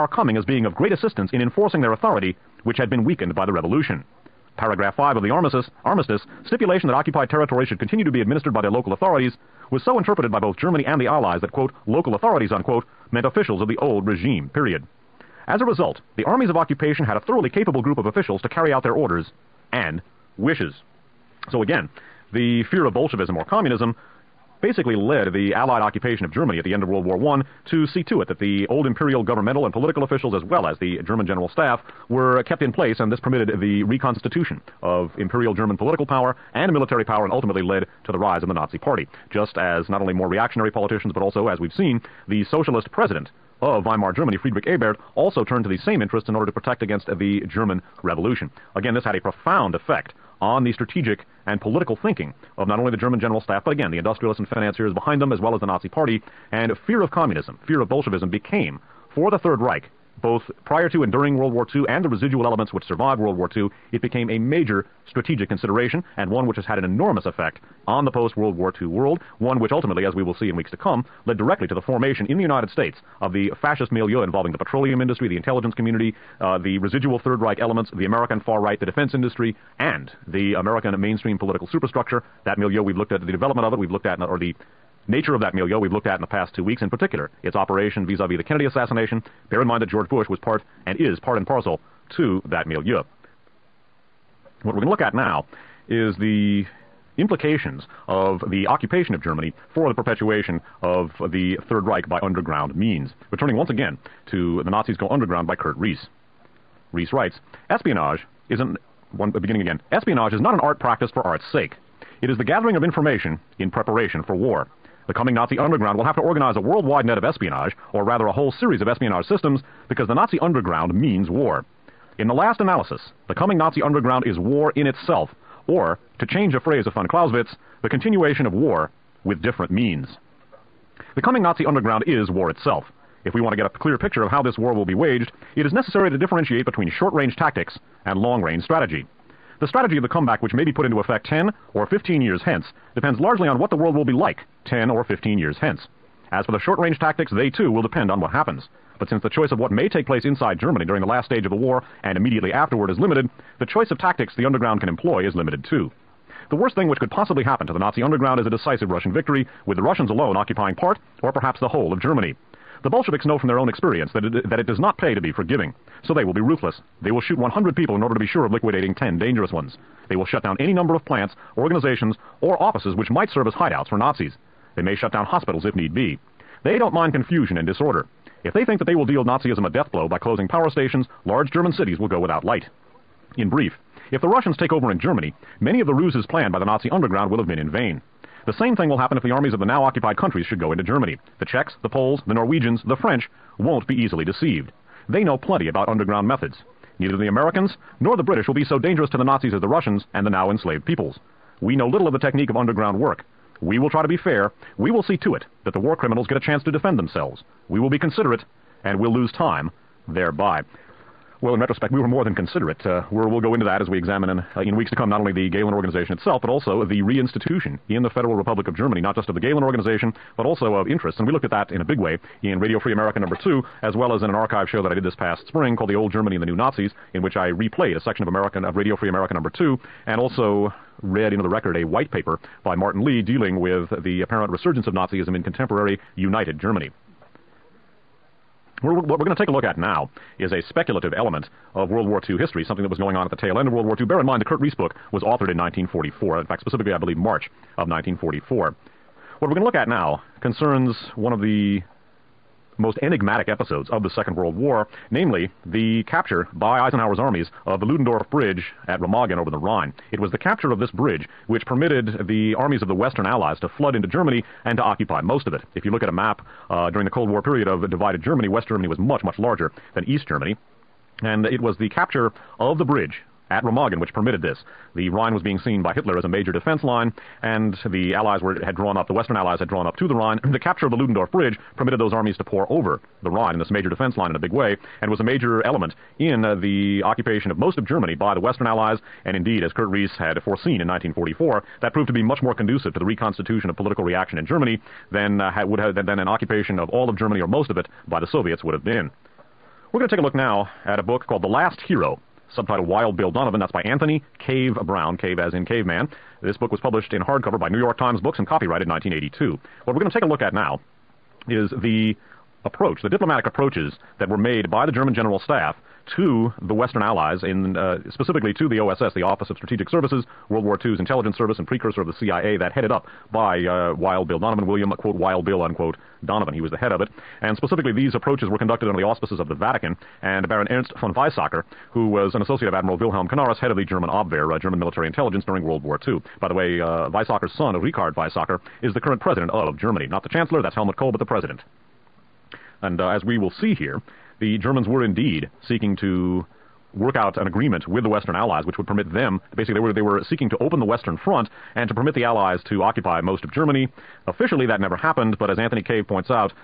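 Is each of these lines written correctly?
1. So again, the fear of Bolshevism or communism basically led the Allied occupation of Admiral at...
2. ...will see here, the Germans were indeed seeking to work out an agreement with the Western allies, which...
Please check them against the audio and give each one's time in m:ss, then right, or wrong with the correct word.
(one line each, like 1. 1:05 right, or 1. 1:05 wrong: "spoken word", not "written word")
1. 0:21 wrong: "Germany", not "Admiral"
2. 5:43 right.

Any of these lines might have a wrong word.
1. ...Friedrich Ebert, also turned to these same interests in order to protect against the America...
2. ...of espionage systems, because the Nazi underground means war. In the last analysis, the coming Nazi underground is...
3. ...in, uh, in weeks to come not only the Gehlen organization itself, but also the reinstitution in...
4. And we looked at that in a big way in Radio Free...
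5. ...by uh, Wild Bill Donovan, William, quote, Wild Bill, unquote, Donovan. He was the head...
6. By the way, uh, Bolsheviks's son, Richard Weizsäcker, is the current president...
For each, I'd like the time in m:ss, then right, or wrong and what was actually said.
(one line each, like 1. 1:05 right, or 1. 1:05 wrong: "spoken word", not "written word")
1. 0:44 wrong: "German", not "America"
2. 1:58 right
3. 3:34 right
4. 3:41 right
5. 5:23 right
6. 5:36 wrong: "Weizsäcker", not "Bolsheviks".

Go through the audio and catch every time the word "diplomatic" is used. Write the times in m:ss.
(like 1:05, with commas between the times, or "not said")
5:13.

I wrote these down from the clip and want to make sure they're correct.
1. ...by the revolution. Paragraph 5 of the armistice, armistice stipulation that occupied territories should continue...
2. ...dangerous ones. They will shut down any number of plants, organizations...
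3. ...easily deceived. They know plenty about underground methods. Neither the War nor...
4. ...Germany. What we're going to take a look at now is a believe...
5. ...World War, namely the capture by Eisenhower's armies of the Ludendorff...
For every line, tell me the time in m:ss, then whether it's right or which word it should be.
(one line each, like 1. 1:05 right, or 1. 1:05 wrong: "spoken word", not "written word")
1. 0:03 right
2. 2:49 right
3. 3:13 wrong: "Americans", not "War"
4. 3:56 wrong: "speculative", not "believe"
5. 4:14 right.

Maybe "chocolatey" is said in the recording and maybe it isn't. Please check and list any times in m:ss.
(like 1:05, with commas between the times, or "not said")
not said.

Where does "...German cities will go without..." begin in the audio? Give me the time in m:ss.
3:01.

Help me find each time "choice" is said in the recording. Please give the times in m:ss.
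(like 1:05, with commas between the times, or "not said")
2:29, 2:33.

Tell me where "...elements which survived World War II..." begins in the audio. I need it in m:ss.
1:02.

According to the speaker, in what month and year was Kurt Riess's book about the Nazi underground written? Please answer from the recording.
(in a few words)
March 1944.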